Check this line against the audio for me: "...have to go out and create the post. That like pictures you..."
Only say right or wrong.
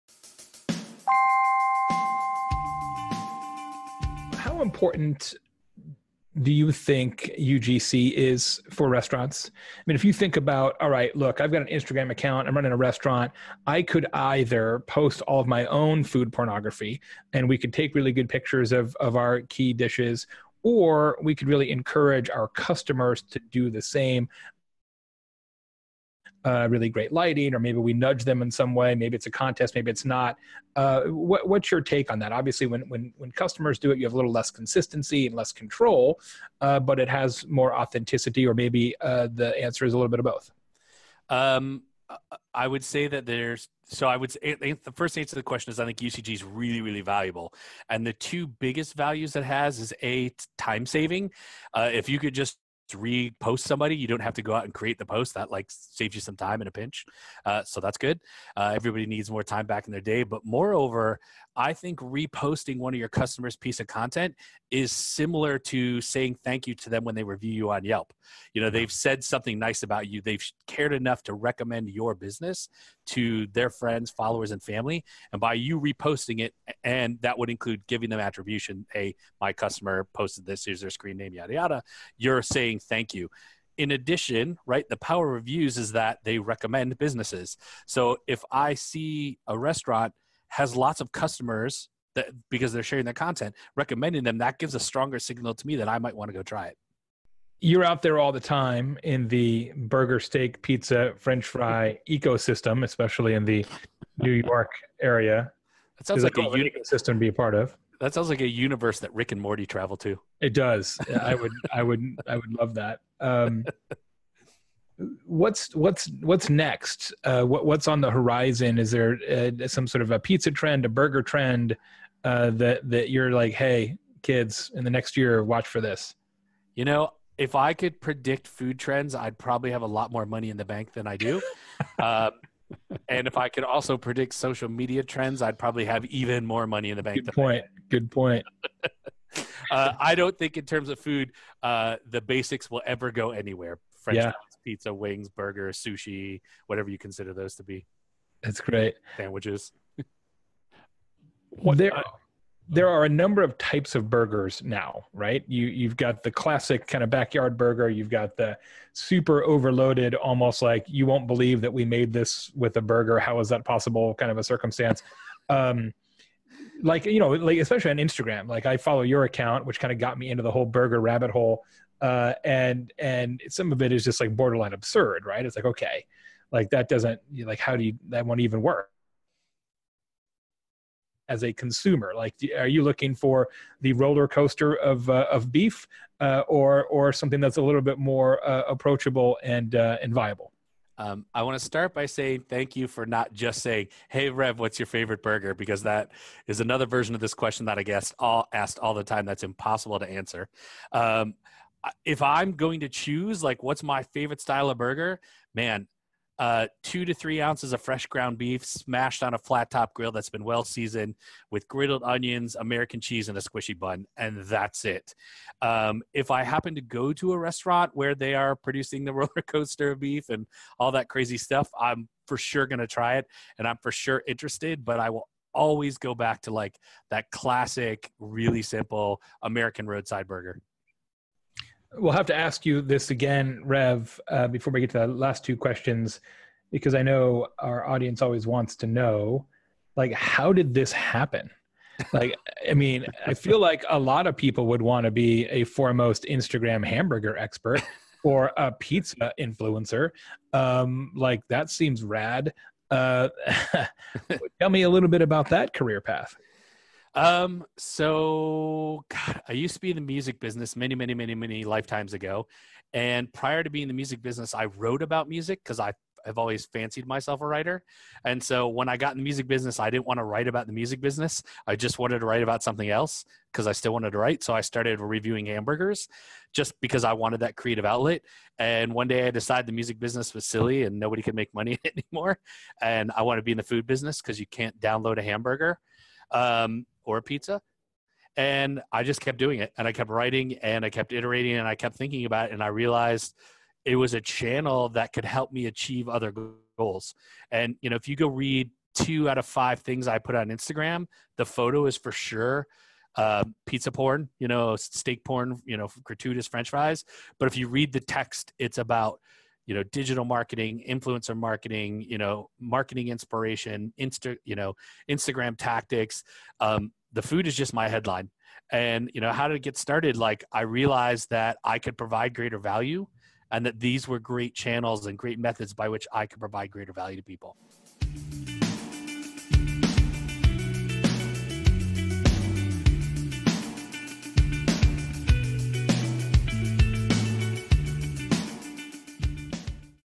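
wrong.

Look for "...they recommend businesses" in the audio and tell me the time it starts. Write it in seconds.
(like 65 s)
86 s.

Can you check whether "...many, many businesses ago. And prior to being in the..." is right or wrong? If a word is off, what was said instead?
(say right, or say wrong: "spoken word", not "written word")
wrong: "lifetimes", not "businesses".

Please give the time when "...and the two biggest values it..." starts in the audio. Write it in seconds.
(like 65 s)
47 s.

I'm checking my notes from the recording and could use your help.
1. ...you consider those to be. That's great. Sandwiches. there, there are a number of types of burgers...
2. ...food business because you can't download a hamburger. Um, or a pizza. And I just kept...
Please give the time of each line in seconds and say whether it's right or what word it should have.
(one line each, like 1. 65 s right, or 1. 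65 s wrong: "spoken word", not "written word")
1. 146 s right
2. 283 s right.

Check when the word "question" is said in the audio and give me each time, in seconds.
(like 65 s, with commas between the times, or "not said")
45 s, 197 s, 235 s.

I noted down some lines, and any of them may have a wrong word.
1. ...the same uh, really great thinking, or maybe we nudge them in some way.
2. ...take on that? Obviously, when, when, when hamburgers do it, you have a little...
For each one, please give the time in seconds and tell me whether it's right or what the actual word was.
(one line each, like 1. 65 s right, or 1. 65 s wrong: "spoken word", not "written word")
1. 23 s wrong: "lighting", not "thinking"
2. 31 s wrong: "customers", not "hamburgers".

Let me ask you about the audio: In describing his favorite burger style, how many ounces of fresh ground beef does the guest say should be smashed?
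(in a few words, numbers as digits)
2 to 3 ounces.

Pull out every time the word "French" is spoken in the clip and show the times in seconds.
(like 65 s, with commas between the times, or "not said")
101 s, 144 s, 306 s.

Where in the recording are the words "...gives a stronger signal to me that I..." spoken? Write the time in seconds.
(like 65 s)
94 s.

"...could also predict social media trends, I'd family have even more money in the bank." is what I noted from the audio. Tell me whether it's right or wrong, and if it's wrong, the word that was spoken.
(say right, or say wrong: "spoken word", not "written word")
wrong: "probably", not "family".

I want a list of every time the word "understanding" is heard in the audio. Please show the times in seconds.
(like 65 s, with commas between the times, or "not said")
not said.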